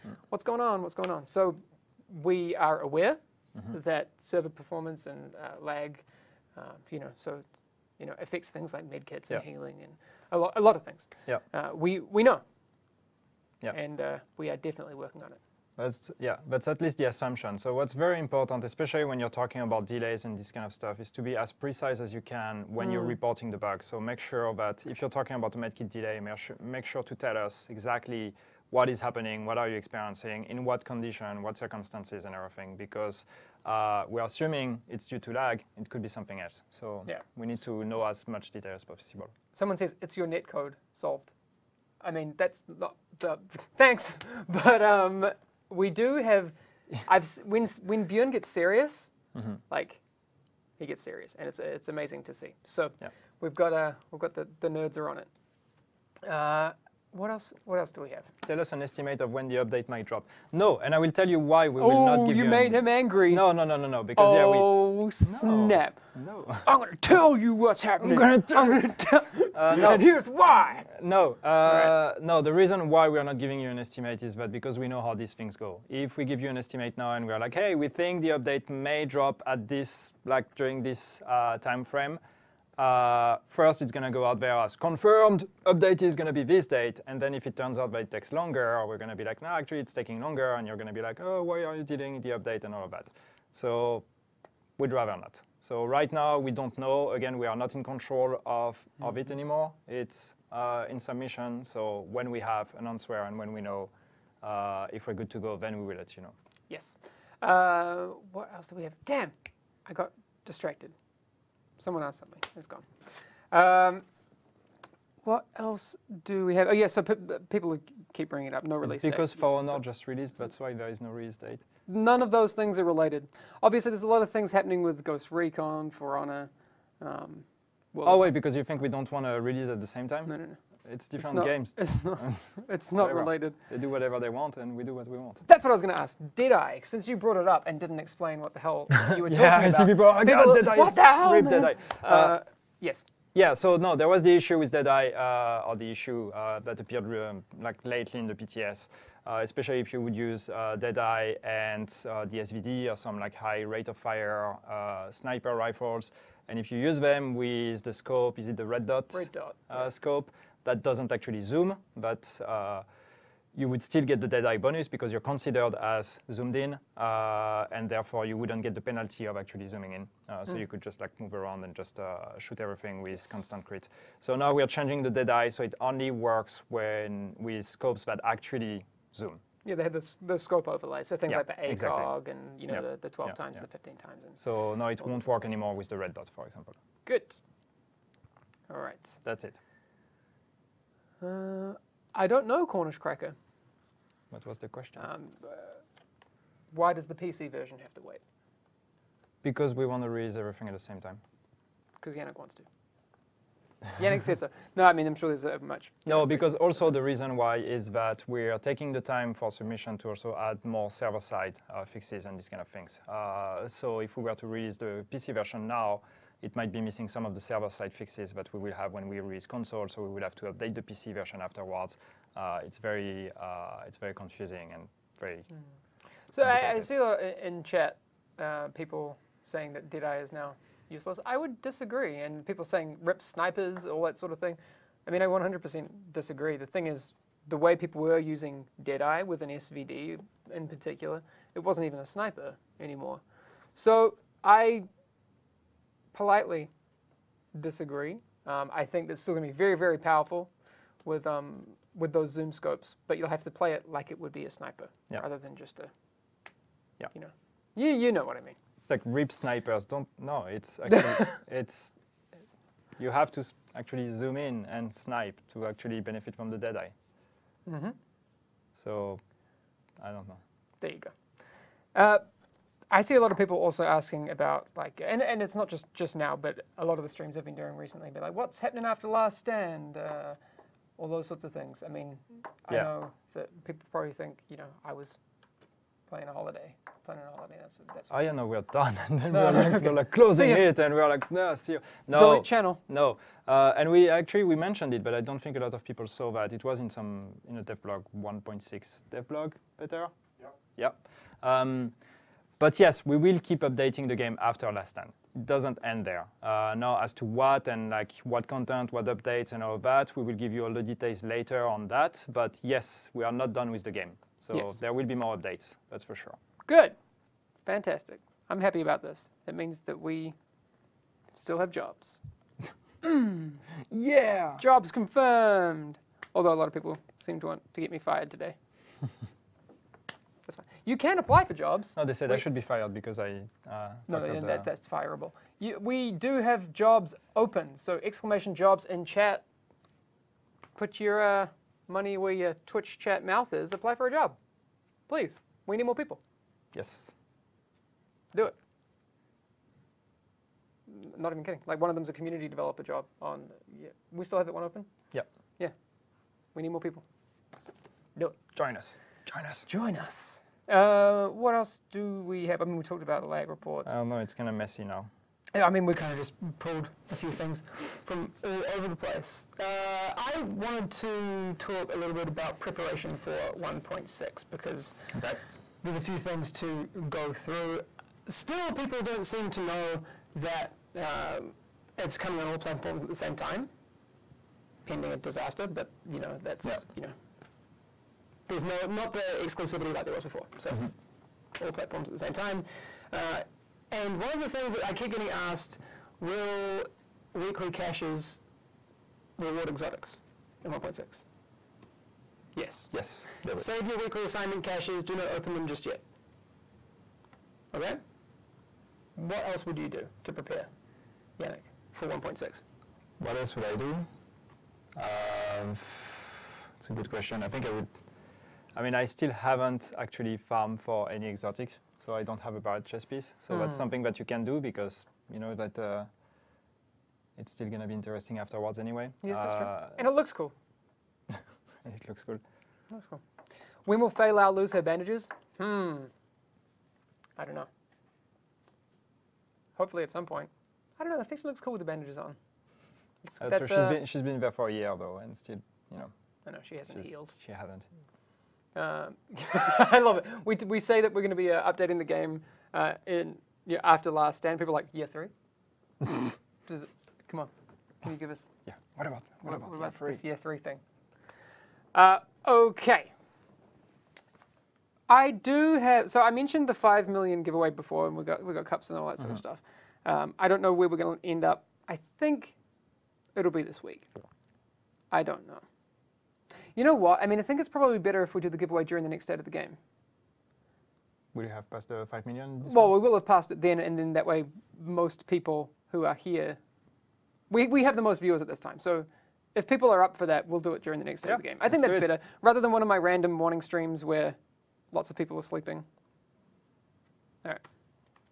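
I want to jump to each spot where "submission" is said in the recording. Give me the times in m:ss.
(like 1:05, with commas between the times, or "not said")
1:40, 3:29.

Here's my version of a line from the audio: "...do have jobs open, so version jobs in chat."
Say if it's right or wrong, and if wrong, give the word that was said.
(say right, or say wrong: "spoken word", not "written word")
wrong: "exclamation", not "version".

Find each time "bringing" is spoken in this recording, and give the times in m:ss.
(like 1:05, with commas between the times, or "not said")
1:58.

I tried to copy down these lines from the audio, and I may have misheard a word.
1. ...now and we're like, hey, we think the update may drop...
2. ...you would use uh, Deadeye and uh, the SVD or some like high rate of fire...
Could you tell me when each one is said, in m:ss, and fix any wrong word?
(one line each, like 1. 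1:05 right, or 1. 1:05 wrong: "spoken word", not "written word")
1. 1:16 right
2. 2:29 right.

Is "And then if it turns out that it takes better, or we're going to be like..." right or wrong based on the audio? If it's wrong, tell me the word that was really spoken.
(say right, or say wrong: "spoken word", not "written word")
wrong: "longer", not "better".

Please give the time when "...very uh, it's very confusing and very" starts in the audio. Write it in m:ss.
3:42.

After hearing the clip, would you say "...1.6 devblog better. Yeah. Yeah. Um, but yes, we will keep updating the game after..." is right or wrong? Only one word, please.
right.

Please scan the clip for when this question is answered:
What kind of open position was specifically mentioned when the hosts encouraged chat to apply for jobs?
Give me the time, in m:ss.
5:52.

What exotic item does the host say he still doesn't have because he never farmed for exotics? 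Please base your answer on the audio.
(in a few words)
barred chess piece.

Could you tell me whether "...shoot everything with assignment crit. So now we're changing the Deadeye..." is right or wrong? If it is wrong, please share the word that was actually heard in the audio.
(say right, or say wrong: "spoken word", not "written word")
wrong: "constant", not "assignment".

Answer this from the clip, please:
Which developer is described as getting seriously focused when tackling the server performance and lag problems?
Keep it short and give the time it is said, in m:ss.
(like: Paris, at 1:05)
Bjorn, at 0:48.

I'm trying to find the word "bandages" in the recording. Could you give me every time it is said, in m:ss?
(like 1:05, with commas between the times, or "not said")
7:14, 7:21.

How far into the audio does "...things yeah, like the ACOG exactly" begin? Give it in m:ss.
3:01.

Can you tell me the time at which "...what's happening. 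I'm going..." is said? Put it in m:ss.
1:07.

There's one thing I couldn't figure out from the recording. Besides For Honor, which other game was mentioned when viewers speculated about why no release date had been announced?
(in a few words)
Ghost Recon.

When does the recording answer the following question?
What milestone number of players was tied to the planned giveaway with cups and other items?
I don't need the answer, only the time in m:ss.
7:46.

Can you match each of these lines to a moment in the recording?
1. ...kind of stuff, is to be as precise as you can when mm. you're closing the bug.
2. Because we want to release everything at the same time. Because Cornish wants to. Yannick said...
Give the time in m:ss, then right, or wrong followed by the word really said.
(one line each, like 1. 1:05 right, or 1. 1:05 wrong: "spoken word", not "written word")
1. 0:20 wrong: "reporting", not "closing"
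2. 3:19 wrong: "Yannick", not "Cornish".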